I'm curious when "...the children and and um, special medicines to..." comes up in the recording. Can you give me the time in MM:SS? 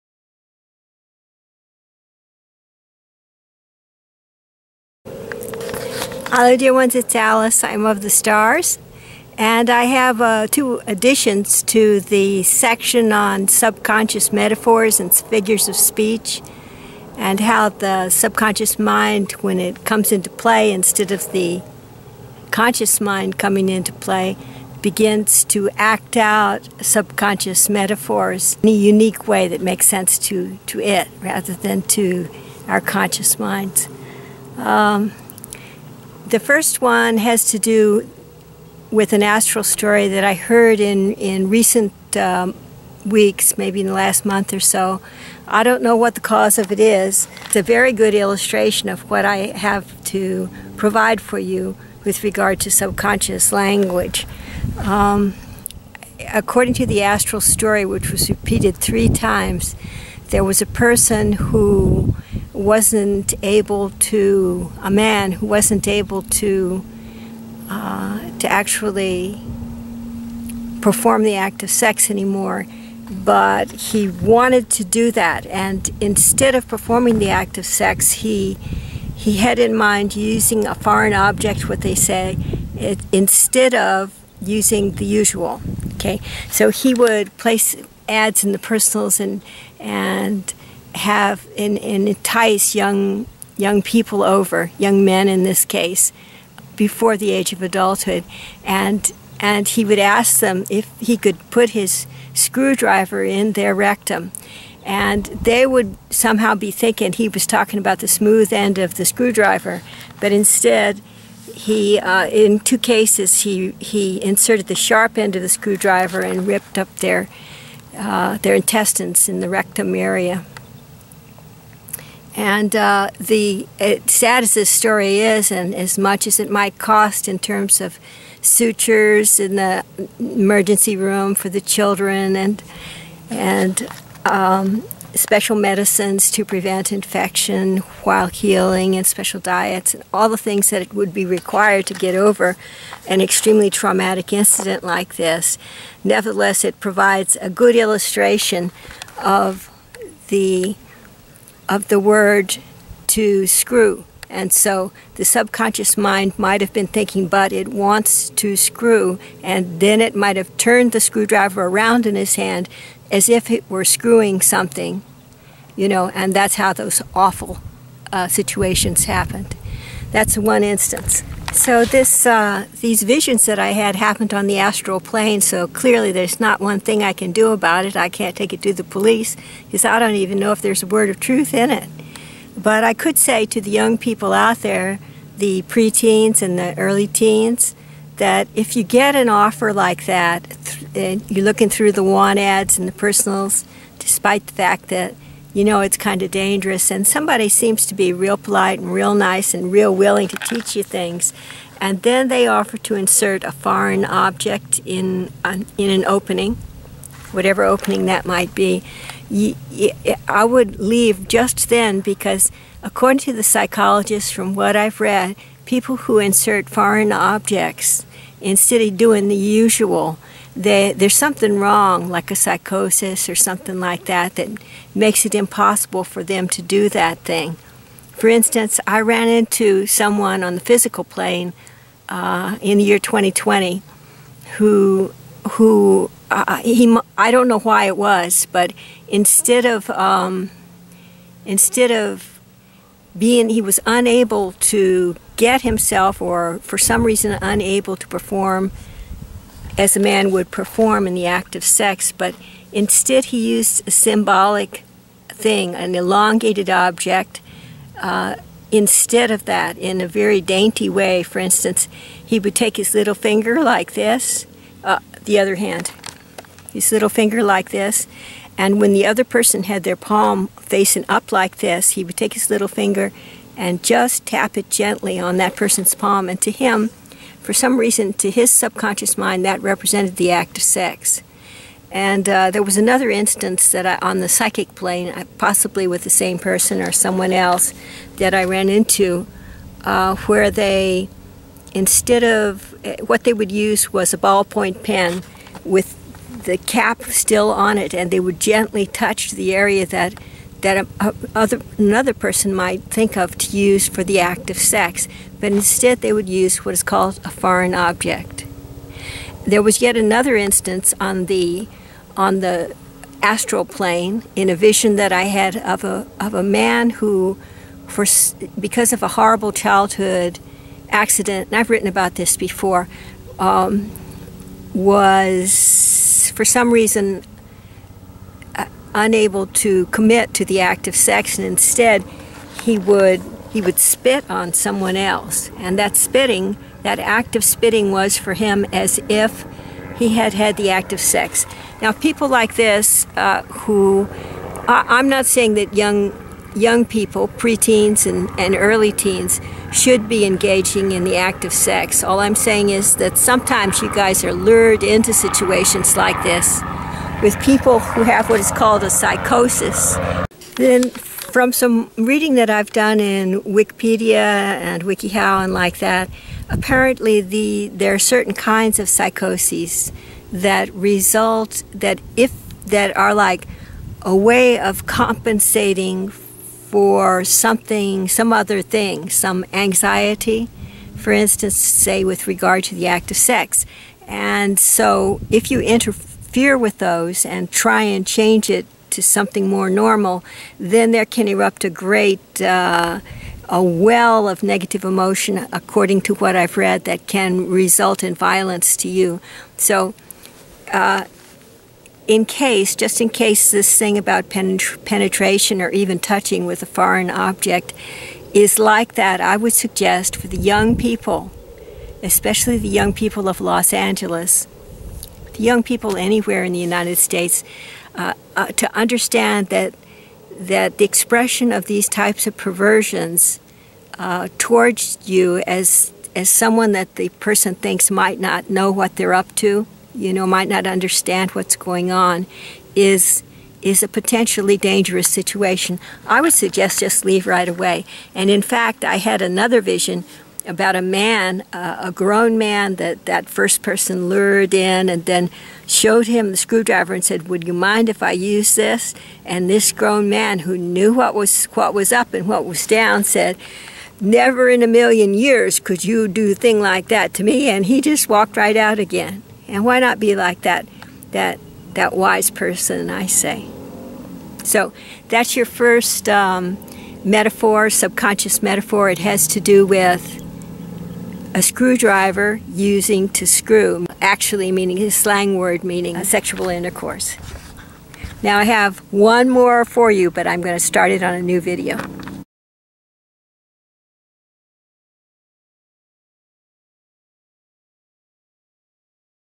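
02:11.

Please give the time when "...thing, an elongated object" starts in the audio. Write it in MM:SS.
04:15.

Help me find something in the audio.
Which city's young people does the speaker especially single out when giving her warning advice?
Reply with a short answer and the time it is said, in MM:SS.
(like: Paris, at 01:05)
Los Angeles, at 06:53.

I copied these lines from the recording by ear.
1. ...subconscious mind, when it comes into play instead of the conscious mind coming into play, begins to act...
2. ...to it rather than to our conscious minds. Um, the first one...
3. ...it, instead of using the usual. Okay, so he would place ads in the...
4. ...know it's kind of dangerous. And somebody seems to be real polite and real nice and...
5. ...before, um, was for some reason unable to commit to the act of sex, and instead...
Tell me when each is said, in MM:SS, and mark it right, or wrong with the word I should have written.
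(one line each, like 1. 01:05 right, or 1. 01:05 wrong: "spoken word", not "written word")
1. 00:18 right
2. 00:30 right
3. 01:22 right
4. 03:15 right
5. 05:22 right.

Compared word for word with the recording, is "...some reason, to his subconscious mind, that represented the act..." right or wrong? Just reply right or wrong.
right.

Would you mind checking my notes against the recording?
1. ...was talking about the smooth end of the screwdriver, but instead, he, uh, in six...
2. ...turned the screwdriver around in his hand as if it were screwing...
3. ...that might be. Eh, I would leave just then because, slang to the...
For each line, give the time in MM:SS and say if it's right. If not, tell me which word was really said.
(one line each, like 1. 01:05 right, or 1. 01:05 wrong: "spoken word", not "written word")
1. 01:47 wrong: "two", not "six"
2. 02:40 right
3. 03:28 wrong: "according", not "slang".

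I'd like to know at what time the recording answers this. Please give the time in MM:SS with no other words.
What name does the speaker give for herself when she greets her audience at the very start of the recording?
00:07.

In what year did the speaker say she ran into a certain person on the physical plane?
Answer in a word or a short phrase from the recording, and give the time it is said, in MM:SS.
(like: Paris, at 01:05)
2020, at 03:52.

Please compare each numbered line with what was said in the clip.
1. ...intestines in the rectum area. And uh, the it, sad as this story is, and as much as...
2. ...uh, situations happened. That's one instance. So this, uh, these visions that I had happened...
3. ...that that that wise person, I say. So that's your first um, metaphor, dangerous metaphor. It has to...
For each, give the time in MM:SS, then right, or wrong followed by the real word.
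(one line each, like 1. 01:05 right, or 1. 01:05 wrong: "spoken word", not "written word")
1. 01:58 right
2. 02:48 right
3. 07:40 wrong: "subconscious", not "dangerous".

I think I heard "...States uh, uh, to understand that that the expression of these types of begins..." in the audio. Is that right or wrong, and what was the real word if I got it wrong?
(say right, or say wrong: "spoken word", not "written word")
wrong: "perversions", not "begins".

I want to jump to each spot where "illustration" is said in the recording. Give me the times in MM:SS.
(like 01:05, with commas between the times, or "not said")
00:48, 02:27.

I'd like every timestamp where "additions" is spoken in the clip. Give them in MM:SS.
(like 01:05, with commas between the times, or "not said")
00:10.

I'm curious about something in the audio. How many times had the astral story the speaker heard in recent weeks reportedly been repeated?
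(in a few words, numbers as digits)
3.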